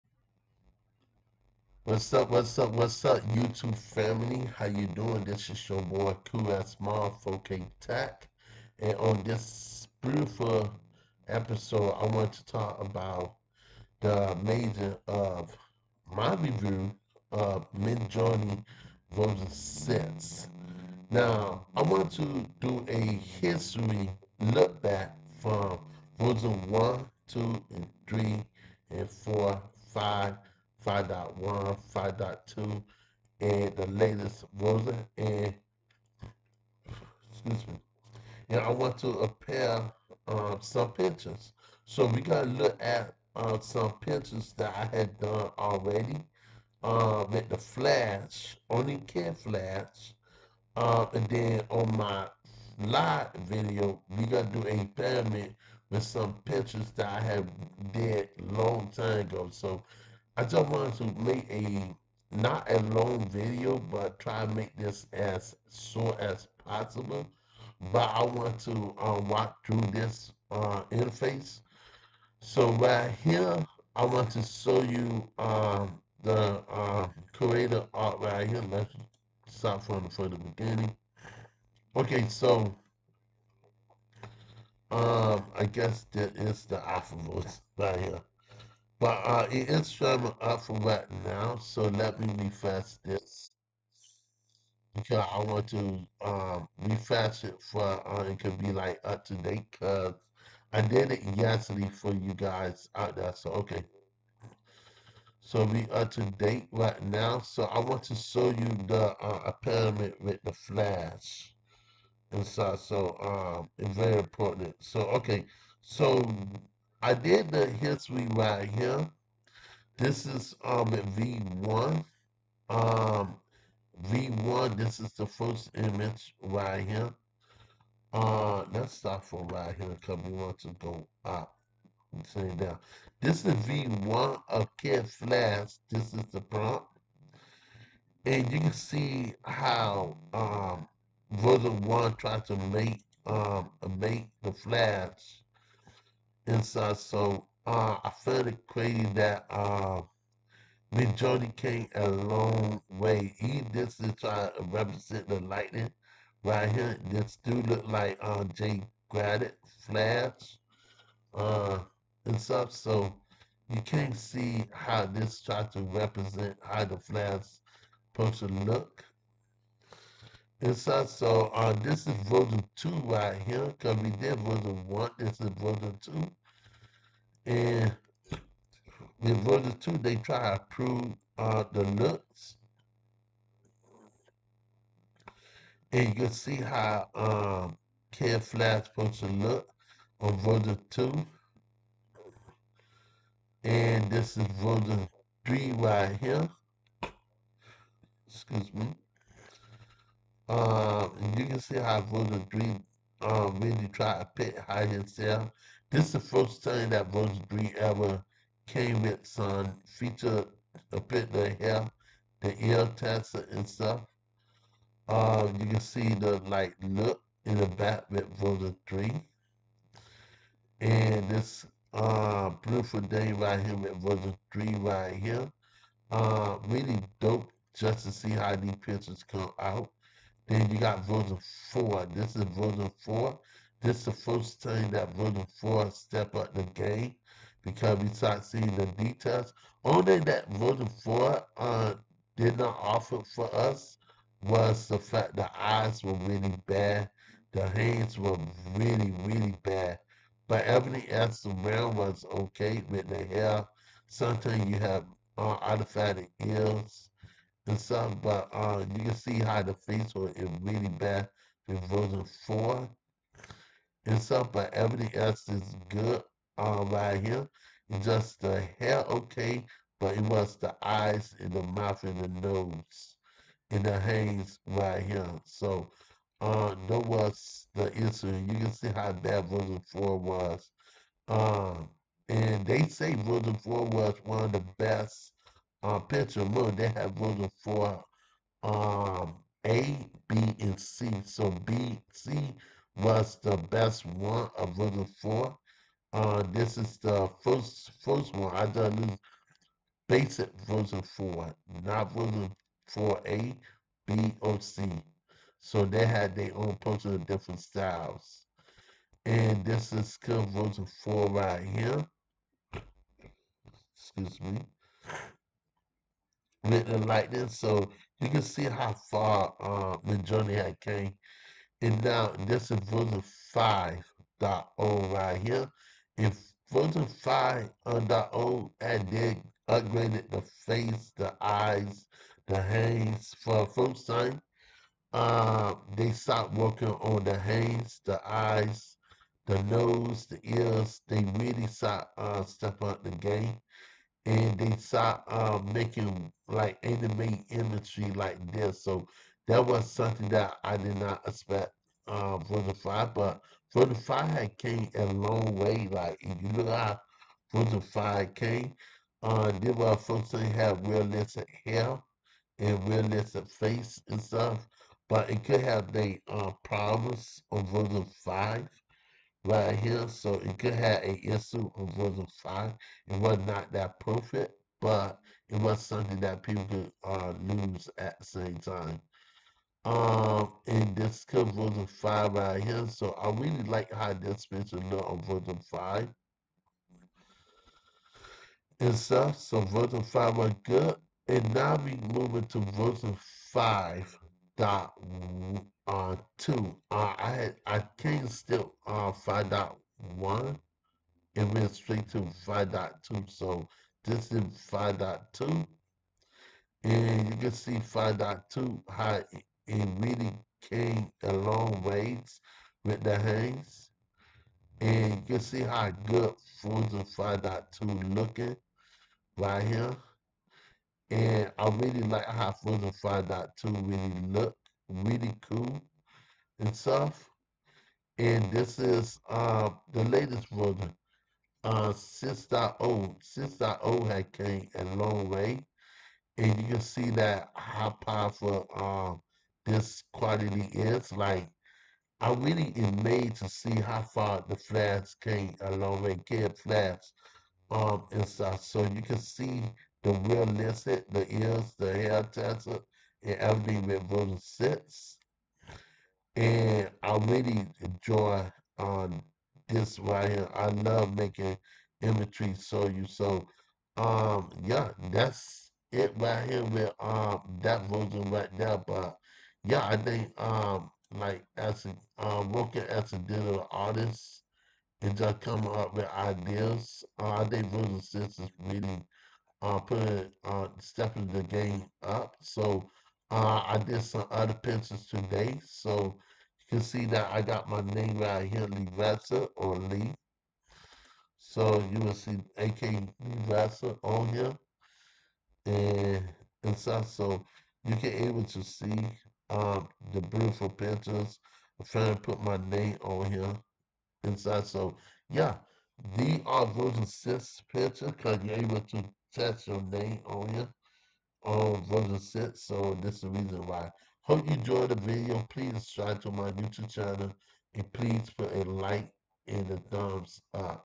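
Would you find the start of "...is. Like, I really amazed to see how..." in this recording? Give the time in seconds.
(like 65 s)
440 s.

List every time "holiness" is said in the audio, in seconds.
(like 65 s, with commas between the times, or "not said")
not said.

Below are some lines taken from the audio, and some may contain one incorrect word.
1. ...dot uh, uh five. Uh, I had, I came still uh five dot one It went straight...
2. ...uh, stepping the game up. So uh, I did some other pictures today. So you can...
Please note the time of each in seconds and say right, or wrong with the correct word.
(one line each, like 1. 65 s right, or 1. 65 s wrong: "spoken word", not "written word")
1. 394 s wrong: "two", not "five"
2. 480 s right.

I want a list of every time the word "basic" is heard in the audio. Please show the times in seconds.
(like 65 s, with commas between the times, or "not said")
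300 s.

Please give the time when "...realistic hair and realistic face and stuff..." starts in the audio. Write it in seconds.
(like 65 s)
360 s.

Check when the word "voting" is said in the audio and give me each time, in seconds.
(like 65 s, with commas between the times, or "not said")
294 s.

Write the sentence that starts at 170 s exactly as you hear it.
And so, so uh, this is version 2 right here, because we did version 1, this is version 2.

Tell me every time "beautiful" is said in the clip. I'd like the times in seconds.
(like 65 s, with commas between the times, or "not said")
9 s, 222 s, 500 s.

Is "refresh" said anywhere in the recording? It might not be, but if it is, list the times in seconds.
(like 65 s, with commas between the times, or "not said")
92 s, 96 s.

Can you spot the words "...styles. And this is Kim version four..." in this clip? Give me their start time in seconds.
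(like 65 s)
307 s.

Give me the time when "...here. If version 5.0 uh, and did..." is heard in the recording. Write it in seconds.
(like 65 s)
325 s.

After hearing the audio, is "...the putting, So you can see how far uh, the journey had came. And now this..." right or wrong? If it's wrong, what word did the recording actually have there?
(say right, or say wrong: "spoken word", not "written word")
wrong: "lightning", not "putting".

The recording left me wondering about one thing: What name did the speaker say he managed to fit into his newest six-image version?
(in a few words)
AK Lee.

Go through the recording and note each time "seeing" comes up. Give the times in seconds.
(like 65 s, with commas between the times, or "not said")
238 s.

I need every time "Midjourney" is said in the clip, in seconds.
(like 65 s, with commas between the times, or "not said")
17 s, 150 s.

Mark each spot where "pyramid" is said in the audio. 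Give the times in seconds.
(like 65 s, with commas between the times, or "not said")
54 s, 109 s.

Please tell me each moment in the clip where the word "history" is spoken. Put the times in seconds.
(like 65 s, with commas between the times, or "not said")
23 s, 117 s.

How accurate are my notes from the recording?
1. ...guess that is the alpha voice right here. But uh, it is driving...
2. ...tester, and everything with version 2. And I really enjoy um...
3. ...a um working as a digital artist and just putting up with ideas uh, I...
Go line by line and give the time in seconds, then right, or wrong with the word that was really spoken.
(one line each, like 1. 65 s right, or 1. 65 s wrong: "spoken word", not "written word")
1. 85 s right
2. 452 s wrong: "6", not "2"
3. 471 s wrong: "coming", not "putting".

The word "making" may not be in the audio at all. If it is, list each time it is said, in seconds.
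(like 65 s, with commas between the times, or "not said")
345 s, 461 s.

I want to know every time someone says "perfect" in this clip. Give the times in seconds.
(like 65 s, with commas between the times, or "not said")
373 s.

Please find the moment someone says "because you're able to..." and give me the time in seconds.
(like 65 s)
508 s.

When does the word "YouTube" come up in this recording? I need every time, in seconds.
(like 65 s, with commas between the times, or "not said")
3 s, 516 s.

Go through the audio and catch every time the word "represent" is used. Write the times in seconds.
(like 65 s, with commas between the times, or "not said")
154 s, 165 s.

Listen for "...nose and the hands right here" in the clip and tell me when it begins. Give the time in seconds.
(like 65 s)
272 s.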